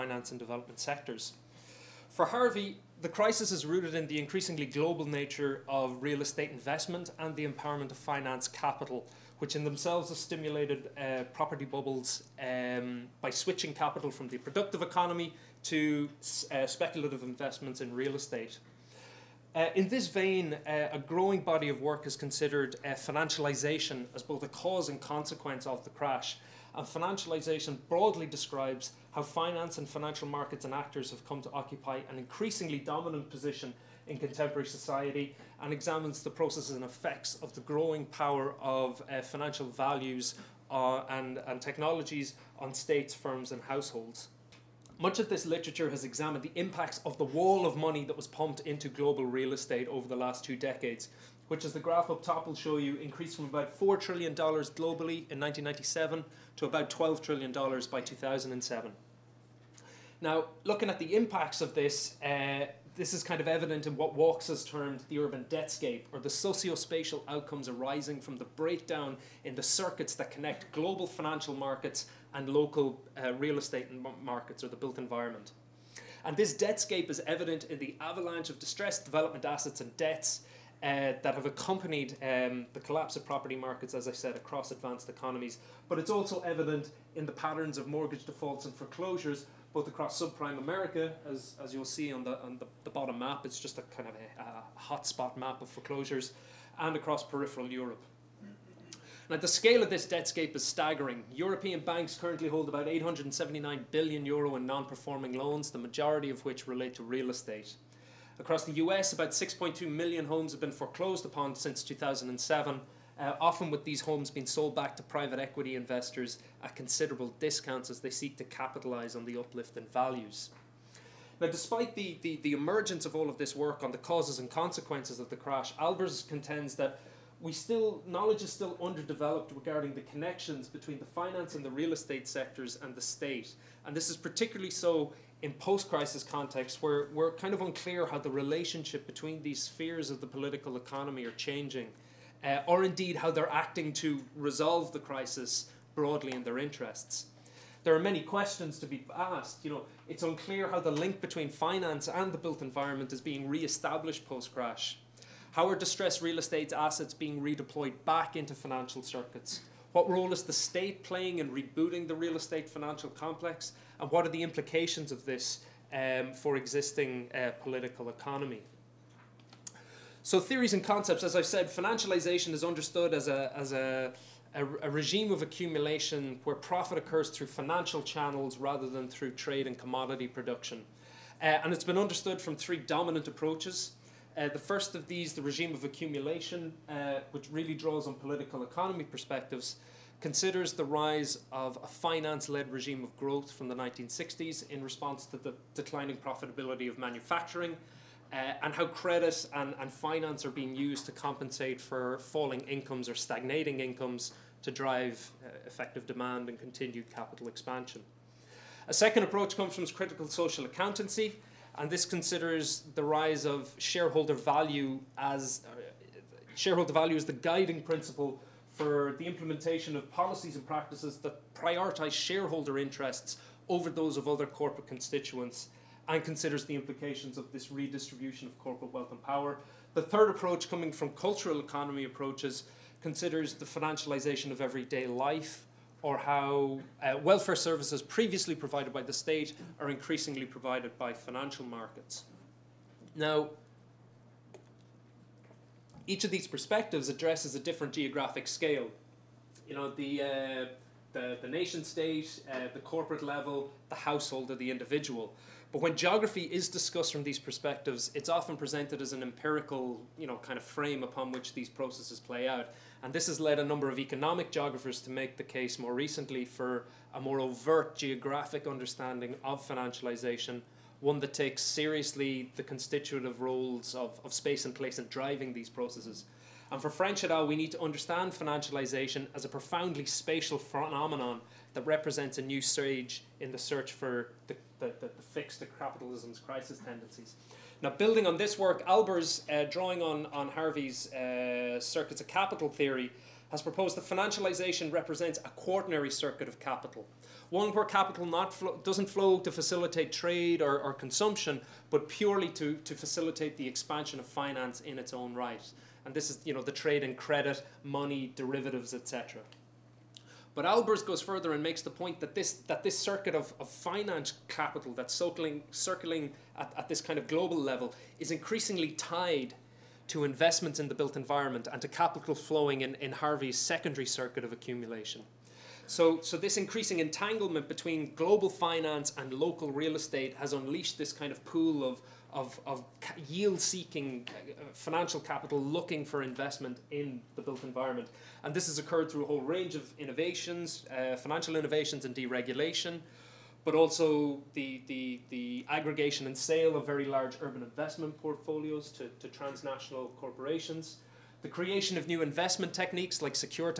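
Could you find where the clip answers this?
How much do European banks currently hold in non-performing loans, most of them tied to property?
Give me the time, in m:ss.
1:42.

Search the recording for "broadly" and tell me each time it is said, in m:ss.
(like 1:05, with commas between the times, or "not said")
0:27, 2:25.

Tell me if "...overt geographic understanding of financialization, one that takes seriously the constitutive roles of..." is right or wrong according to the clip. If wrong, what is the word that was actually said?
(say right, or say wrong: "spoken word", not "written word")
right.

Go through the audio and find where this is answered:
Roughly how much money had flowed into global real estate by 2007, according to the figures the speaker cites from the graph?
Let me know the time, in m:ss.
0:56.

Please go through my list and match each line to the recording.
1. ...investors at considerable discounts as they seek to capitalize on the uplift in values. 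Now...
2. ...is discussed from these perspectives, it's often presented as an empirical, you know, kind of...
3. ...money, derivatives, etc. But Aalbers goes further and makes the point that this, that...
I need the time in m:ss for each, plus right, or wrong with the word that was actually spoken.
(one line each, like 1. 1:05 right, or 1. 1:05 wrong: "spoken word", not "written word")
1. 1:55 right
2. 4:16 right
3. 5:07 right.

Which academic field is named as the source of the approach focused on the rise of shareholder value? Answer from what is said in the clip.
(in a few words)
critical social accountancy.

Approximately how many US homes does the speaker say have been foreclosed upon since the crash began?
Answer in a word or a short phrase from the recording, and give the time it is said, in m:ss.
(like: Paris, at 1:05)
6.2 million, at 1:49.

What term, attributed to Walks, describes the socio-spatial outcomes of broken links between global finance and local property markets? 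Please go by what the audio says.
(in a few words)
urban debtscape.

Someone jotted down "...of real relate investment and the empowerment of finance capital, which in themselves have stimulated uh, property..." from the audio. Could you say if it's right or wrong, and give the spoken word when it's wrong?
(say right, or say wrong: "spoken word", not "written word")
wrong: "estate", not "relate".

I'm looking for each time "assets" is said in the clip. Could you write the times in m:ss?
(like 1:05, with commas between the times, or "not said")
1:19, 2:36.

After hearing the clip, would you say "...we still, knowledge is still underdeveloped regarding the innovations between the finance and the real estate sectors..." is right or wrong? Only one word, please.
wrong.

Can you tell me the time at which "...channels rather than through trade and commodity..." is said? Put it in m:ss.
2:58.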